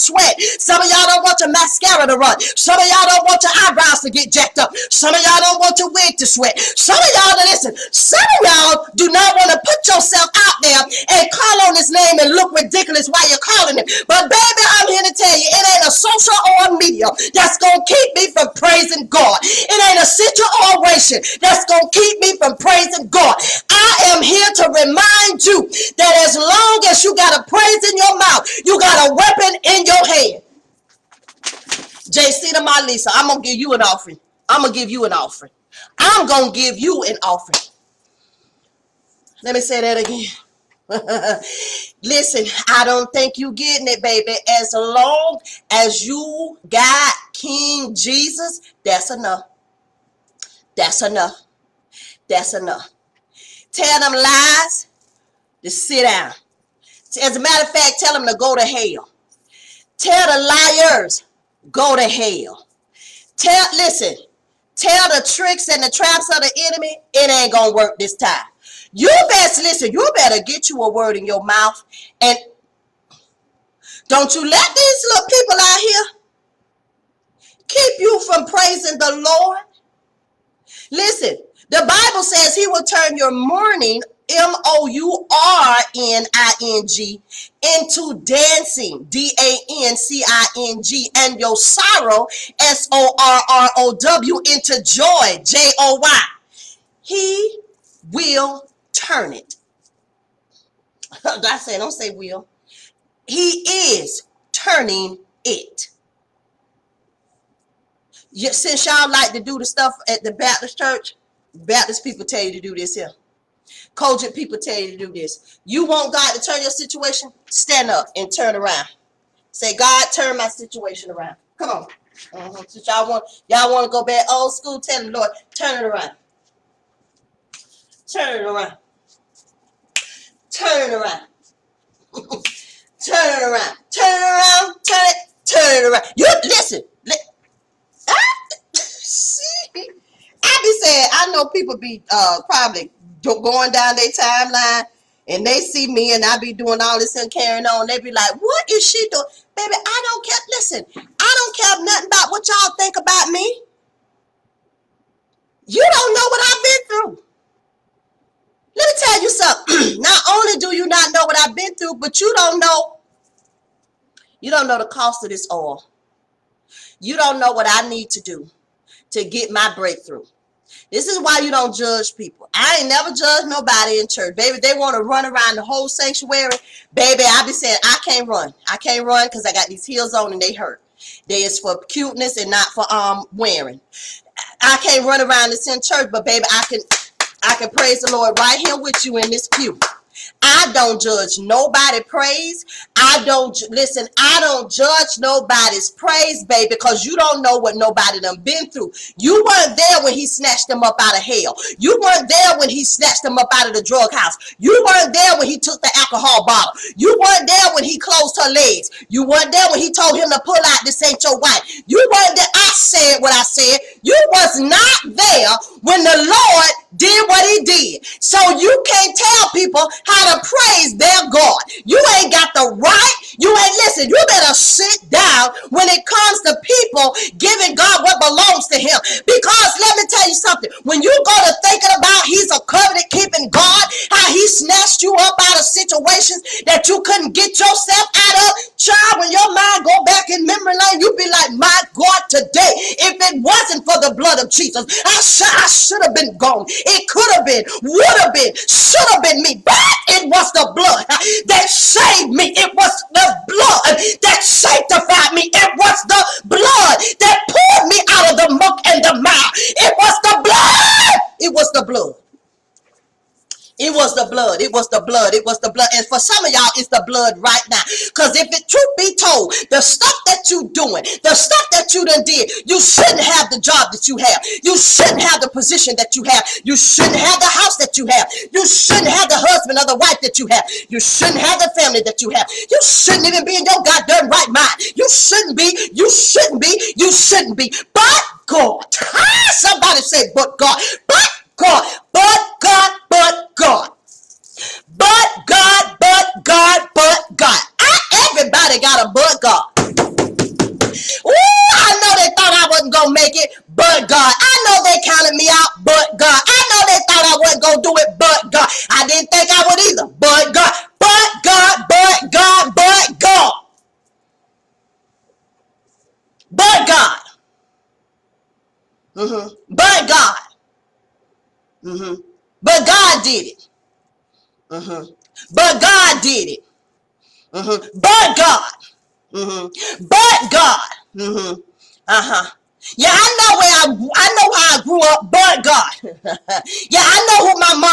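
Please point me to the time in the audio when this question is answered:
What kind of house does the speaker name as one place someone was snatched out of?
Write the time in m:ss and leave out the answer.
3:23.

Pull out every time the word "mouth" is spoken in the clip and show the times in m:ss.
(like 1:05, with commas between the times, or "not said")
0:28, 1:11.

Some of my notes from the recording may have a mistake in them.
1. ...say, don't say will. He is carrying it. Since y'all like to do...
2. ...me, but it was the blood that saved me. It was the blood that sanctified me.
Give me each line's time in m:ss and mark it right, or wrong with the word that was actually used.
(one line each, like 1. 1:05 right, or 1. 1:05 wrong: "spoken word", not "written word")
1. 1:41 wrong: "turning", not "carrying"
2. 4:09 right.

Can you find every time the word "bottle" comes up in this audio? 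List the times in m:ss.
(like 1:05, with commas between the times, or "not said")
3:26.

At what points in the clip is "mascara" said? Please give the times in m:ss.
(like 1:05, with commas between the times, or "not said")
0:01.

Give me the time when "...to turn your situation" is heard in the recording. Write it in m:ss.
1:56.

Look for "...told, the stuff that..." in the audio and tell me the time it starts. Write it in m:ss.
4:29.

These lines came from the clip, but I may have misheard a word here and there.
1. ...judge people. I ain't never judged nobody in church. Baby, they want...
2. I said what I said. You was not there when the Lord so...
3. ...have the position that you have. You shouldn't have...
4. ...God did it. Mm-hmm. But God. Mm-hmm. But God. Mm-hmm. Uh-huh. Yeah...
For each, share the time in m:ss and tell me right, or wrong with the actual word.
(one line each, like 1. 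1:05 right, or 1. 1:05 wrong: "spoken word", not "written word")
1. 2:51 right
2. 3:32 right
3. 4:35 right
4. 5:25 right.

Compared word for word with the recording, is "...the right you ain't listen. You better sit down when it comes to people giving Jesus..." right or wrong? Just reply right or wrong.
wrong.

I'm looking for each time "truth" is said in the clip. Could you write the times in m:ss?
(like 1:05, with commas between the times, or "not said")
4:28.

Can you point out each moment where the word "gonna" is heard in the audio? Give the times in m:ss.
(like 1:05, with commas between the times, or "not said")
0:17, 0:21, 1:07.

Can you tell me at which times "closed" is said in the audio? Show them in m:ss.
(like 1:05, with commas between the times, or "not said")
3:27.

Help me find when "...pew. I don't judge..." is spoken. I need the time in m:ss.
3:09.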